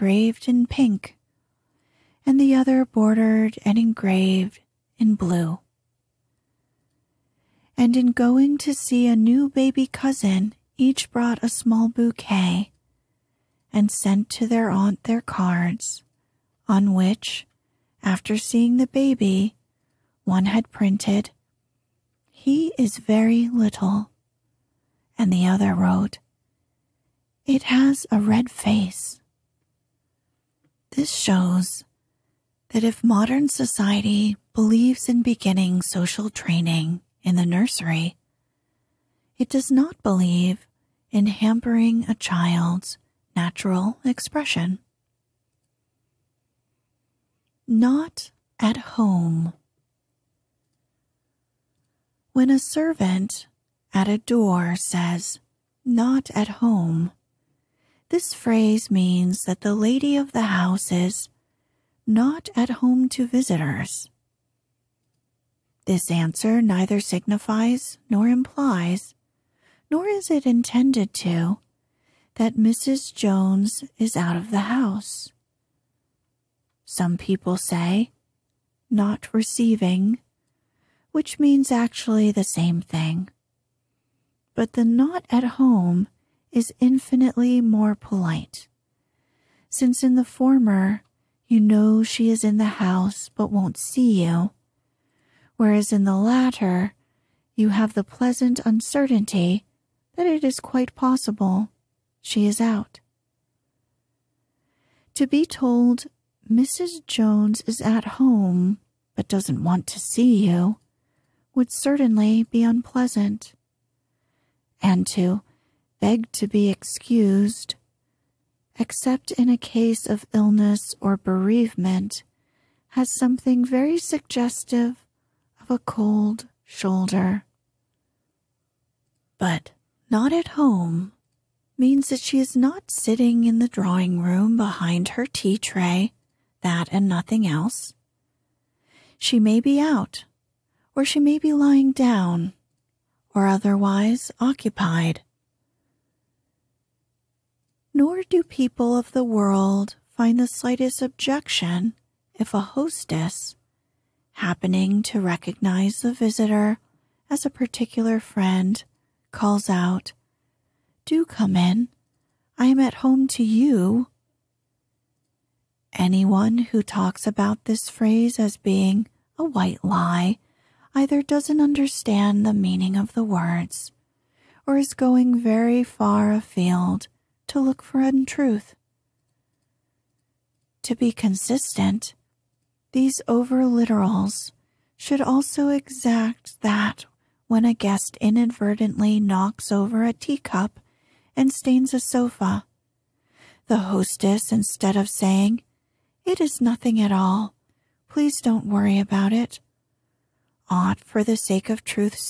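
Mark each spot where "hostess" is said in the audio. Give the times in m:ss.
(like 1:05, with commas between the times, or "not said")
2:32, 3:13.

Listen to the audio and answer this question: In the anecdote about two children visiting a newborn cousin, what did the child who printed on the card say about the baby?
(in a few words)
He is very little.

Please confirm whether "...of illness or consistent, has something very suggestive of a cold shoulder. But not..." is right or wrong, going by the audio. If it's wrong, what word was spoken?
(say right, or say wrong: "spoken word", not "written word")
wrong: "bereavement", not "consistent".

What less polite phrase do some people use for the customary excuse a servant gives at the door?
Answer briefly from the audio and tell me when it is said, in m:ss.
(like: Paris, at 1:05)
not receiving, at 1:18.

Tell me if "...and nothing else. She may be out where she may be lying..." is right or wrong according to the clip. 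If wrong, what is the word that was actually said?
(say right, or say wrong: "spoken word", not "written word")
right.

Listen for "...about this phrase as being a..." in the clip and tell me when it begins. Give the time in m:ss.
2:47.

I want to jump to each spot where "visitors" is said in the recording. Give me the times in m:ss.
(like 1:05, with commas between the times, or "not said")
1:03, 2:36.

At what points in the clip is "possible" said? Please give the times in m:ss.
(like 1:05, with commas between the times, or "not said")
1:40.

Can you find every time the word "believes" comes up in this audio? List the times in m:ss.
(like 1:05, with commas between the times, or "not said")
0:34, 0:40.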